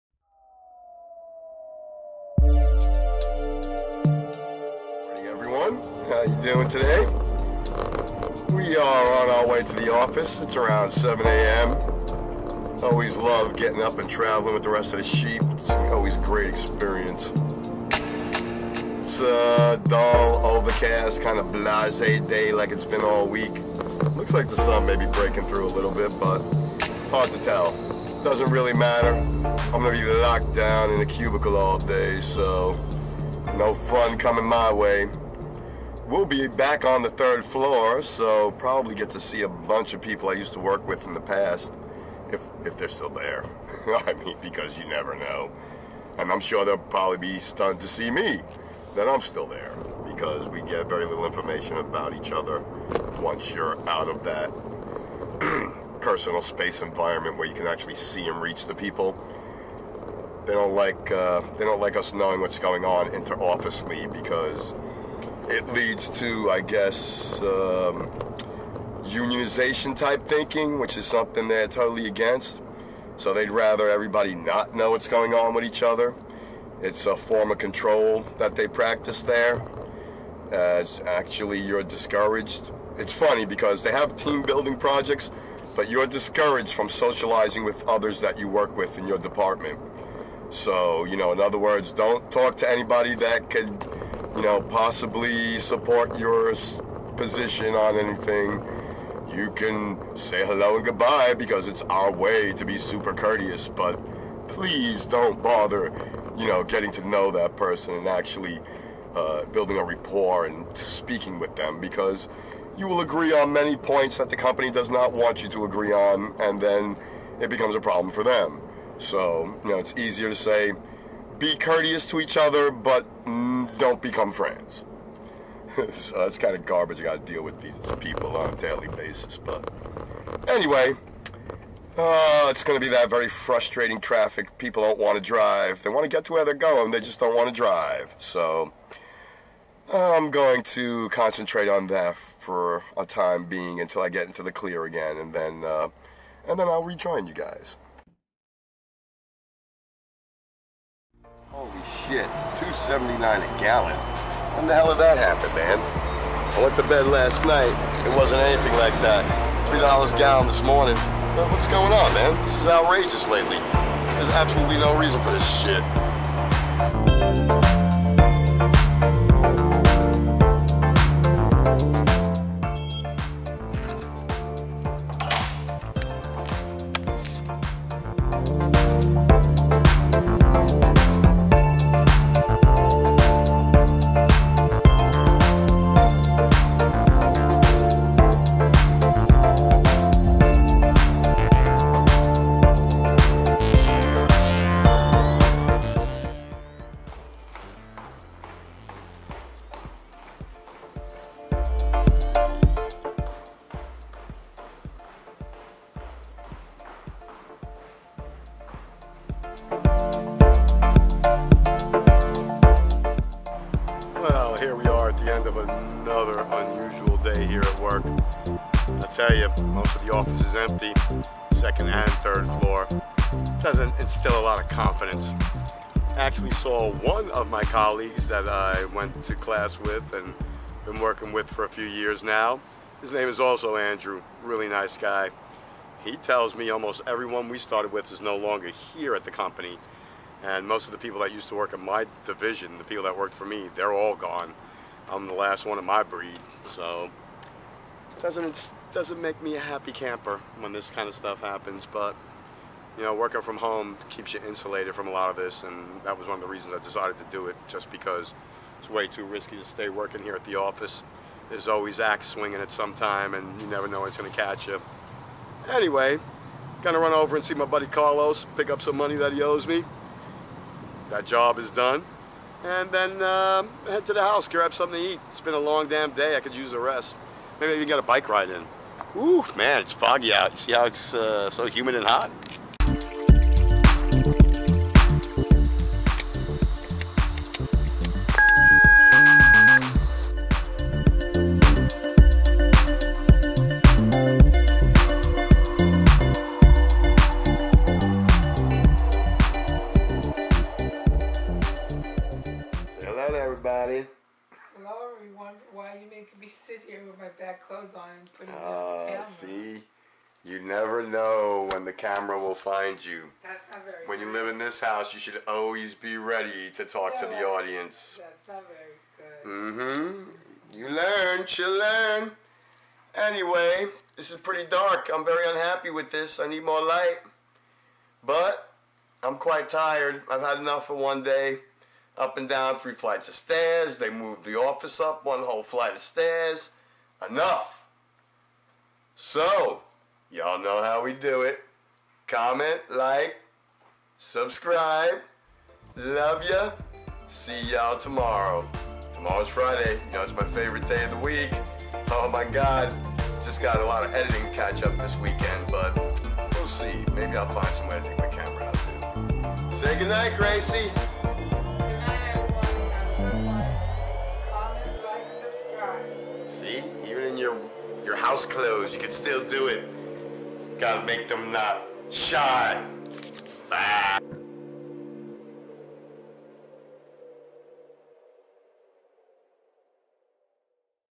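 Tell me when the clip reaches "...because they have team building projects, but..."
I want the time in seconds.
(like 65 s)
83 s.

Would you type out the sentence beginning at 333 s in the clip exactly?
They moved the office up one whole flight of stairs.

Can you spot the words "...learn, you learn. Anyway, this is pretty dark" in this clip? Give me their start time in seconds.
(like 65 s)
320 s.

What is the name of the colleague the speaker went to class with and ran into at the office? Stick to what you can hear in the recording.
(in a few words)
Andrew.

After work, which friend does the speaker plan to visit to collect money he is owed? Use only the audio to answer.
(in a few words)
Carlos.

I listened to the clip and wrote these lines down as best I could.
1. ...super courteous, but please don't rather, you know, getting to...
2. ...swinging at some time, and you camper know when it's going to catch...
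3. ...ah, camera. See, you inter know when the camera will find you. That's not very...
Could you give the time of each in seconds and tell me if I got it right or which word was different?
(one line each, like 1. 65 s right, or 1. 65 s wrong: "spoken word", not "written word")
1. 102 s wrong: "bother", not "rather"
2. 262 s wrong: "never", not "camper"
3. 308 s wrong: "never", not "inter".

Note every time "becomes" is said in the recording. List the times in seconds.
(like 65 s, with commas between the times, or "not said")
117 s, 123 s.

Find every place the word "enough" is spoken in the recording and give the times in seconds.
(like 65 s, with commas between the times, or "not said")
330 s, 337 s.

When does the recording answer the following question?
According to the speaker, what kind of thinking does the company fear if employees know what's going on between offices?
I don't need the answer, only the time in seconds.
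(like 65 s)
69 s.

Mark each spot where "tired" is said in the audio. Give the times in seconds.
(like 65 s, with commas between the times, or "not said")
329 s.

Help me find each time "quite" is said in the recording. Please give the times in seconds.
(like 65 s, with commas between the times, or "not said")
329 s.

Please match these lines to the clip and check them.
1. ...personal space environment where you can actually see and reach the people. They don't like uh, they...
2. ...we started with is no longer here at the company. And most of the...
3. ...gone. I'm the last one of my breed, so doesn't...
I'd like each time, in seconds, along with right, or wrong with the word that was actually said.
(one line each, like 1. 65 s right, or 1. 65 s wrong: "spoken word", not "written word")
1. 56 s right
2. 237 s right
3. 244 s right.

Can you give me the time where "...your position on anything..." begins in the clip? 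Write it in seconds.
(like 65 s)
96 s.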